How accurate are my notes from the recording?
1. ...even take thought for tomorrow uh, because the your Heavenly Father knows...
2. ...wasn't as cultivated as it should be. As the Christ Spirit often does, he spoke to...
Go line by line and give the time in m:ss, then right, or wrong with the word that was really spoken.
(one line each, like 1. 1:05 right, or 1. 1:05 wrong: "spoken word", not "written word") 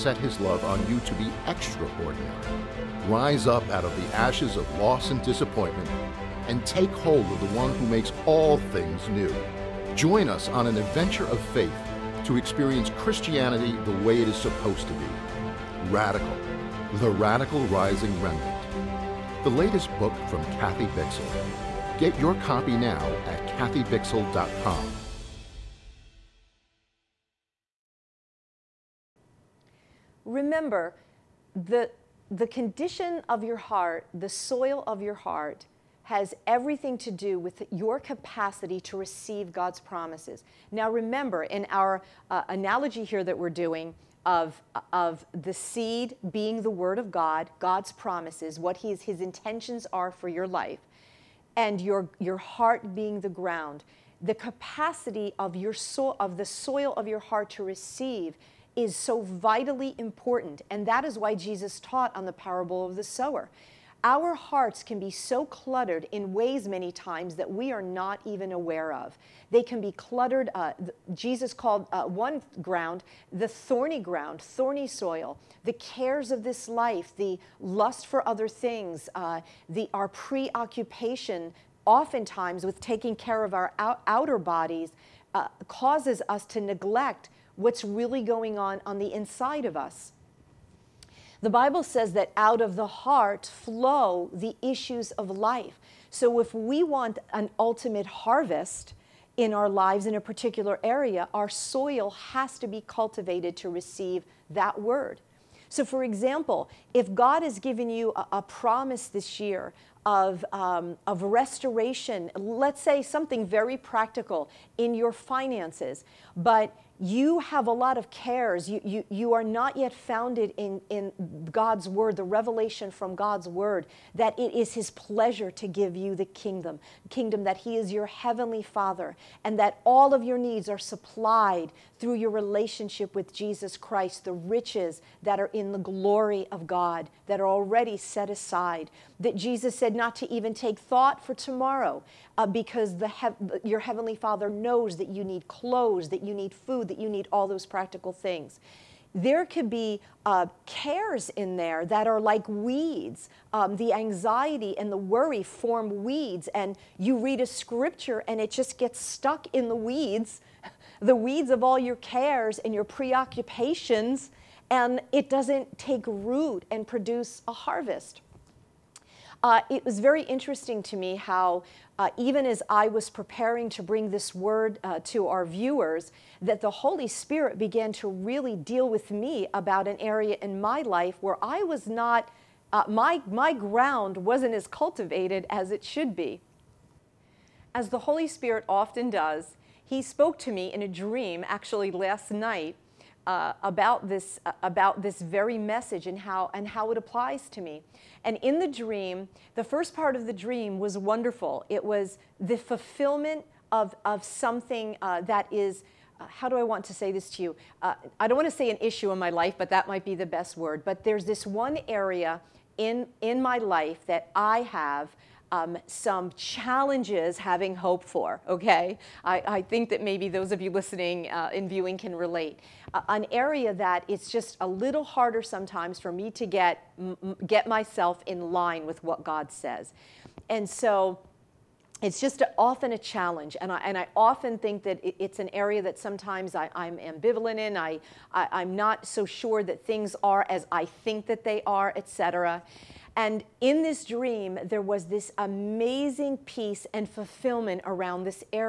1. 2:20 right
2. 3:04 wrong: "Holy", not "Christ".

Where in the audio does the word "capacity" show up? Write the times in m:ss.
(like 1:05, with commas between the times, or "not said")
0:37, 0:54.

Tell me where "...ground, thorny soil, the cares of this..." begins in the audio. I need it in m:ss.
1:13.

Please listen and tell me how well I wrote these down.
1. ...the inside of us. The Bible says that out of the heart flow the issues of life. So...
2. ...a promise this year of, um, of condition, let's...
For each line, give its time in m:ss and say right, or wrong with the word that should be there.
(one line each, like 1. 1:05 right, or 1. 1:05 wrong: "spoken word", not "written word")
1. 1:28 right
2. 1:48 wrong: "restoration", not "condition".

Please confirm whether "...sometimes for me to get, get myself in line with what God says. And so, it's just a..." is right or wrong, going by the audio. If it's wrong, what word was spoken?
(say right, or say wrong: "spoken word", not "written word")
right.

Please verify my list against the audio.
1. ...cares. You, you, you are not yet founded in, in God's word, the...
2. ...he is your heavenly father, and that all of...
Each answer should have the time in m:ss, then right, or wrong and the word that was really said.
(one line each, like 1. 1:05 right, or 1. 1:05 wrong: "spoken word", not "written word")
1. 1:58 right
2. 2:07 right.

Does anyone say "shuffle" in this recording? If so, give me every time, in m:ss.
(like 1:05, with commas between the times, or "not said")
not said.